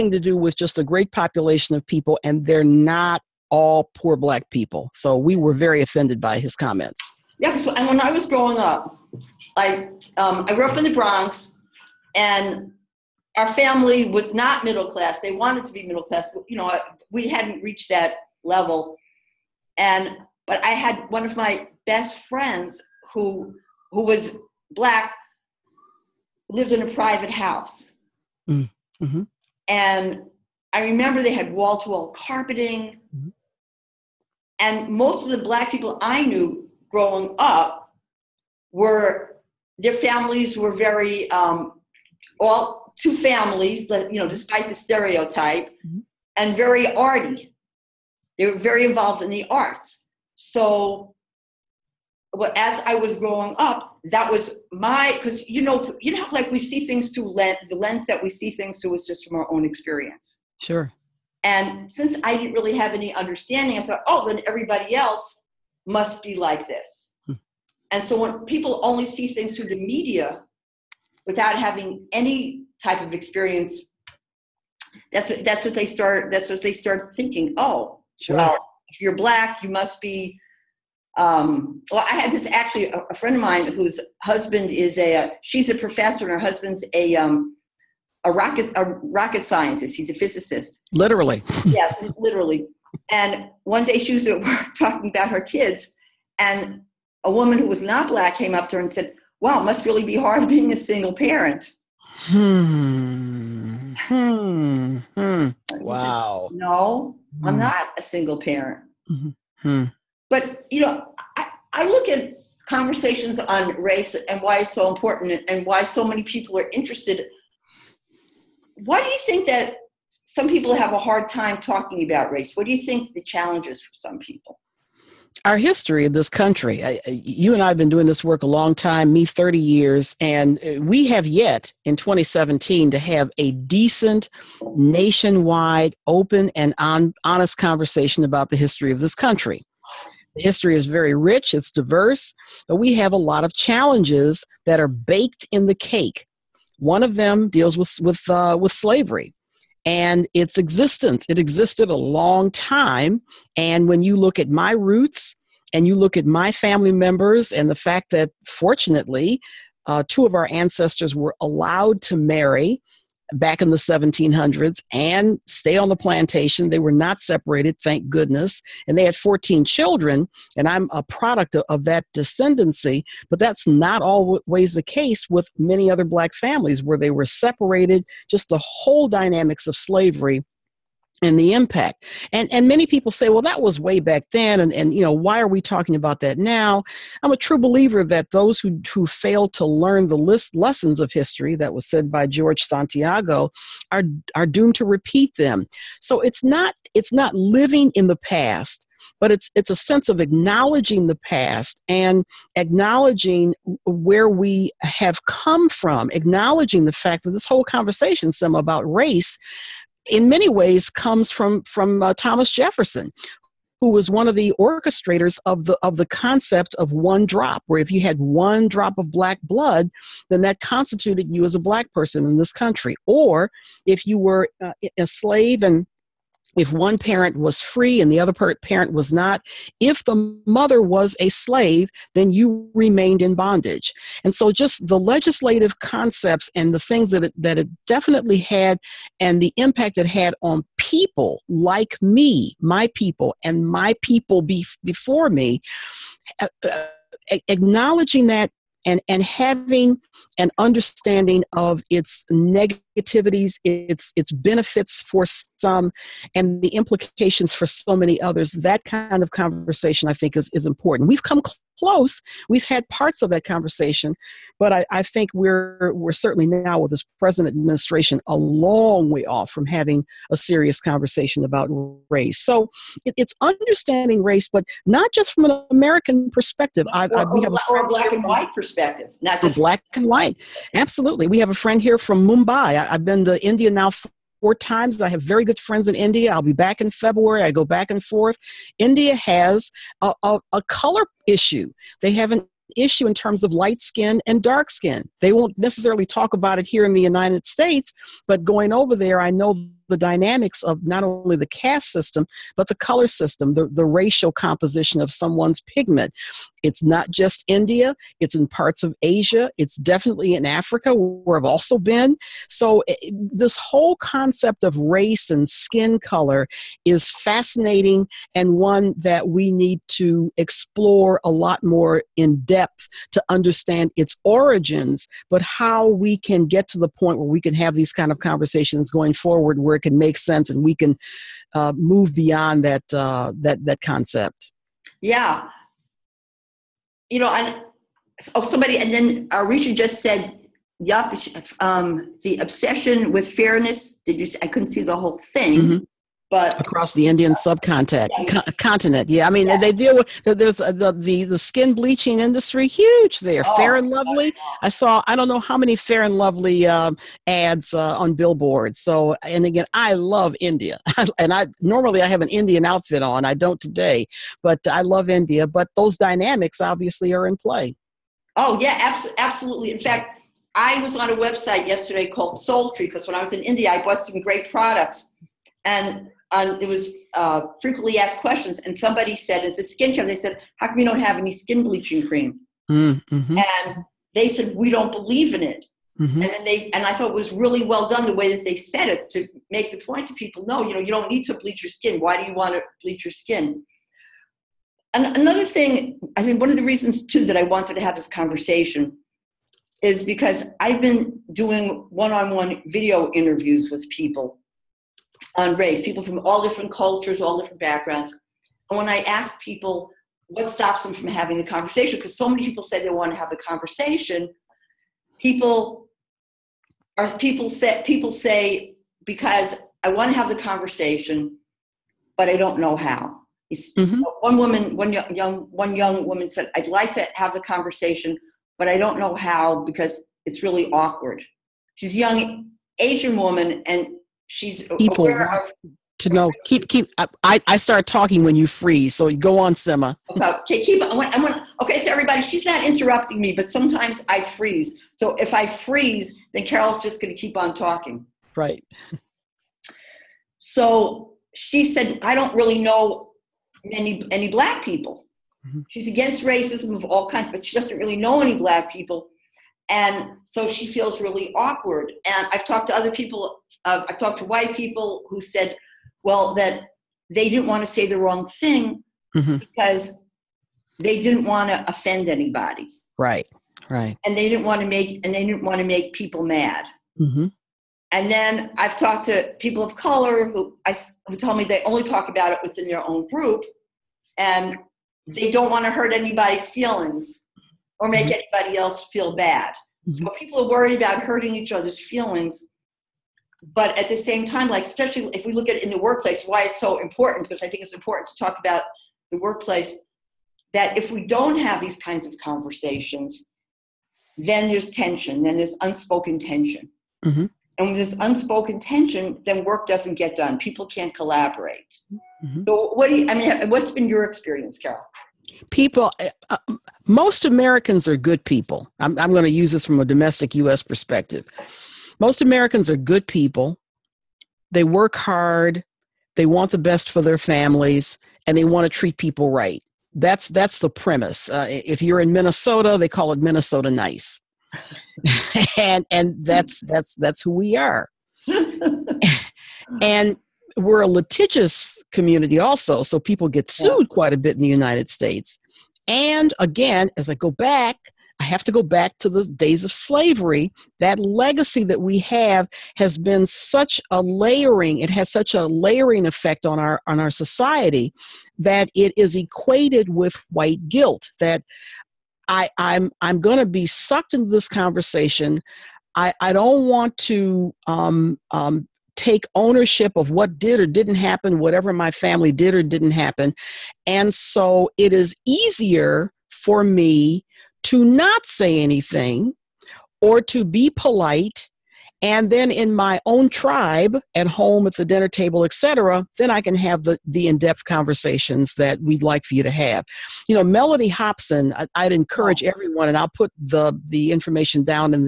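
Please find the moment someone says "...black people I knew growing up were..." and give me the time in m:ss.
0:35.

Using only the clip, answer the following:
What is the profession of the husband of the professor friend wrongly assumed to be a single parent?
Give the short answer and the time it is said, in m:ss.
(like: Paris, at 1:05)
Physicist, at 1:29.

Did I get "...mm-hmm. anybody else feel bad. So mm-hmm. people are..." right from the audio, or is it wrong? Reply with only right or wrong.
right.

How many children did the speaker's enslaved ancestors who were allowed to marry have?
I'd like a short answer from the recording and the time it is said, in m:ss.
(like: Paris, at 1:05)
14, at 2:49.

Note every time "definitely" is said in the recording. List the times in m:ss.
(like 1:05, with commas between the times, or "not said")
3:57, 5:09.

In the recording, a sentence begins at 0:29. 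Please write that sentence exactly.
And I remember they had wall to wall carpeting.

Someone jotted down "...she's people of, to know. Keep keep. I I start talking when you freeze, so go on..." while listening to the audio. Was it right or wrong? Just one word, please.
right.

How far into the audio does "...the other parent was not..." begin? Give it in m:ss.
3:48.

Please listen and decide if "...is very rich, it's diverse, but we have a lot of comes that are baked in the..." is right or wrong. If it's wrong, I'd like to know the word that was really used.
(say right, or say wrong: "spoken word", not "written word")
wrong: "challenges", not "comes".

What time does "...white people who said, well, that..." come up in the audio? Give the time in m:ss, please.
7:44.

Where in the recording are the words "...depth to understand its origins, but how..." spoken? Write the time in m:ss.
5:22.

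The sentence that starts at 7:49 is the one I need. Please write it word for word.
because they didn't want to offend anybody.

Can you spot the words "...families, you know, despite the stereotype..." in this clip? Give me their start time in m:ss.
0:43.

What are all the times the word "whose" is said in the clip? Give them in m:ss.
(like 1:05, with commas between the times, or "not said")
1:23.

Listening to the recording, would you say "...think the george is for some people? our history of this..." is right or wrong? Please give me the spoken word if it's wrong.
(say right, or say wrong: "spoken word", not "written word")
wrong: "challenge", not "george".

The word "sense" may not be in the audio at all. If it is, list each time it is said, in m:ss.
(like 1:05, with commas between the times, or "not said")
3:19, 5:30.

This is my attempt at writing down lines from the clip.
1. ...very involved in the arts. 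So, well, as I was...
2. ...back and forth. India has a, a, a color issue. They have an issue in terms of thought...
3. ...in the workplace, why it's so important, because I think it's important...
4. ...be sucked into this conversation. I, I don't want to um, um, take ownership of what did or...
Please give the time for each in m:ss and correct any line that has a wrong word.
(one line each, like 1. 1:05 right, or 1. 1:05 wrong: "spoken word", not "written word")
1. 0:48 right
2. 4:47 wrong: "light", not "thought"
3. 8:15 right
4. 9:23 right.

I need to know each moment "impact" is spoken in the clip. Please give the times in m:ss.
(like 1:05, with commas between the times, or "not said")
3:01, 3:59.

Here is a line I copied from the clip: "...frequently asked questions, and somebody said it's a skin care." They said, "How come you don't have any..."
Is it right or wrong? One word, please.
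right.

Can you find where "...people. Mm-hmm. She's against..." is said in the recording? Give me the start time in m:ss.
7:34.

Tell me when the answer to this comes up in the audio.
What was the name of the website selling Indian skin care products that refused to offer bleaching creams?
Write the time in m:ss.
6:12.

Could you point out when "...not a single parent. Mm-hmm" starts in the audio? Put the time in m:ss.
1:47.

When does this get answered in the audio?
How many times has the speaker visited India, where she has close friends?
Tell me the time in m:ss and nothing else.
4:44.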